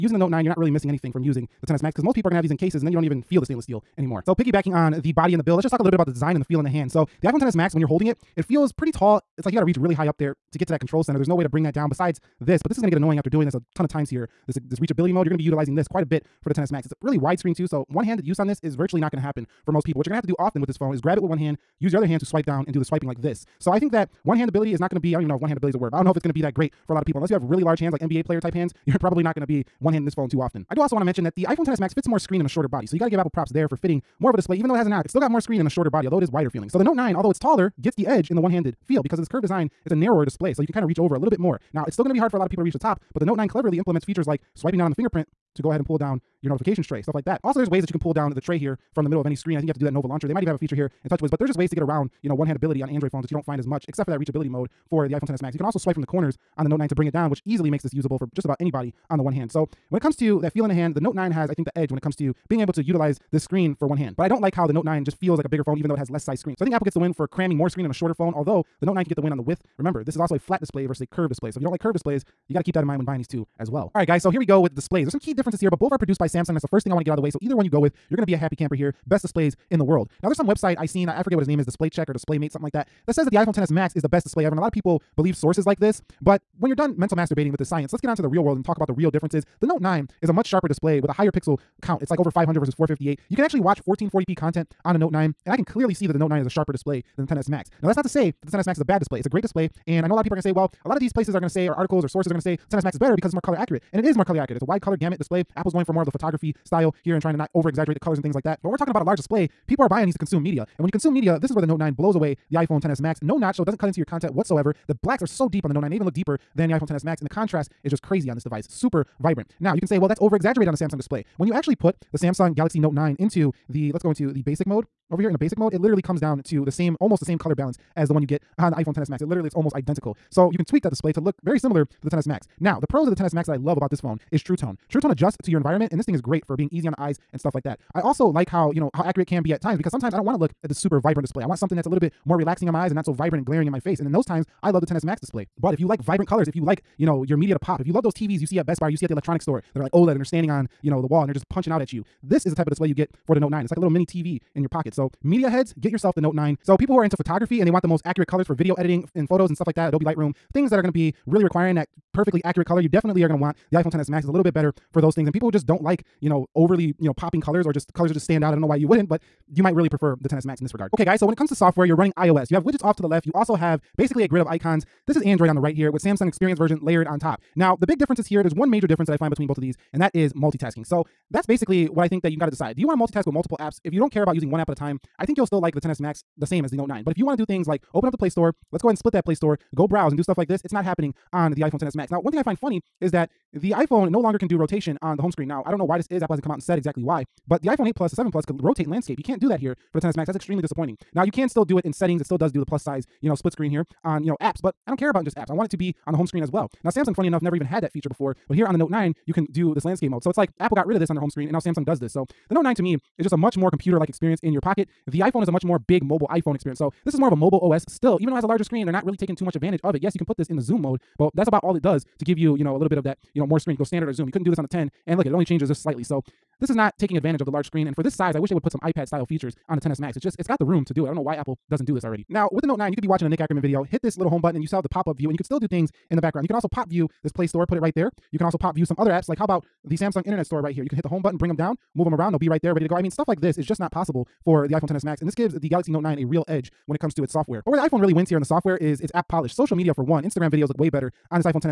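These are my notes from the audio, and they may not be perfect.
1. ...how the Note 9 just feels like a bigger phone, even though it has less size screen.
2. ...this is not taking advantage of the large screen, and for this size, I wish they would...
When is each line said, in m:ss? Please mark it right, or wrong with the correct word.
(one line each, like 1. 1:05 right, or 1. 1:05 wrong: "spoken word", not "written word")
1. 1:04 right
2. 3:46 right.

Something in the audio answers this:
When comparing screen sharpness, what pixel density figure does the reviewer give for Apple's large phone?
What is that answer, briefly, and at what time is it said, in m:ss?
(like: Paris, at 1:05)
458, at 1:32.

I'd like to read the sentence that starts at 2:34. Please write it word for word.
So, media heads, get yourself the Note 9.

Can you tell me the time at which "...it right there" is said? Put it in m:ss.
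3:57.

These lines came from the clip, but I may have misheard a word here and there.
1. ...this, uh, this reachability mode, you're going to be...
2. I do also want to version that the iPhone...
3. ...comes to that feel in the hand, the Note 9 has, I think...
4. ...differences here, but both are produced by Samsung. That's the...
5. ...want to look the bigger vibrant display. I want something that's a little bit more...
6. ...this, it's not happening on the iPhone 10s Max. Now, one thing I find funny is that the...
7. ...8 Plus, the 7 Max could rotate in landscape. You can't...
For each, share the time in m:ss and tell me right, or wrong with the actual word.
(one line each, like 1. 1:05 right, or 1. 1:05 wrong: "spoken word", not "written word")
1. 0:14 right
2. 0:30 wrong: "mention", not "version"
3. 1:00 right
4. 1:15 right
5. 2:20 wrong: "super", not "bigger"
6. 3:10 right
7. 3:17 wrong: "Plus", not "Max".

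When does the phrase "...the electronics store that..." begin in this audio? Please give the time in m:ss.
2:29.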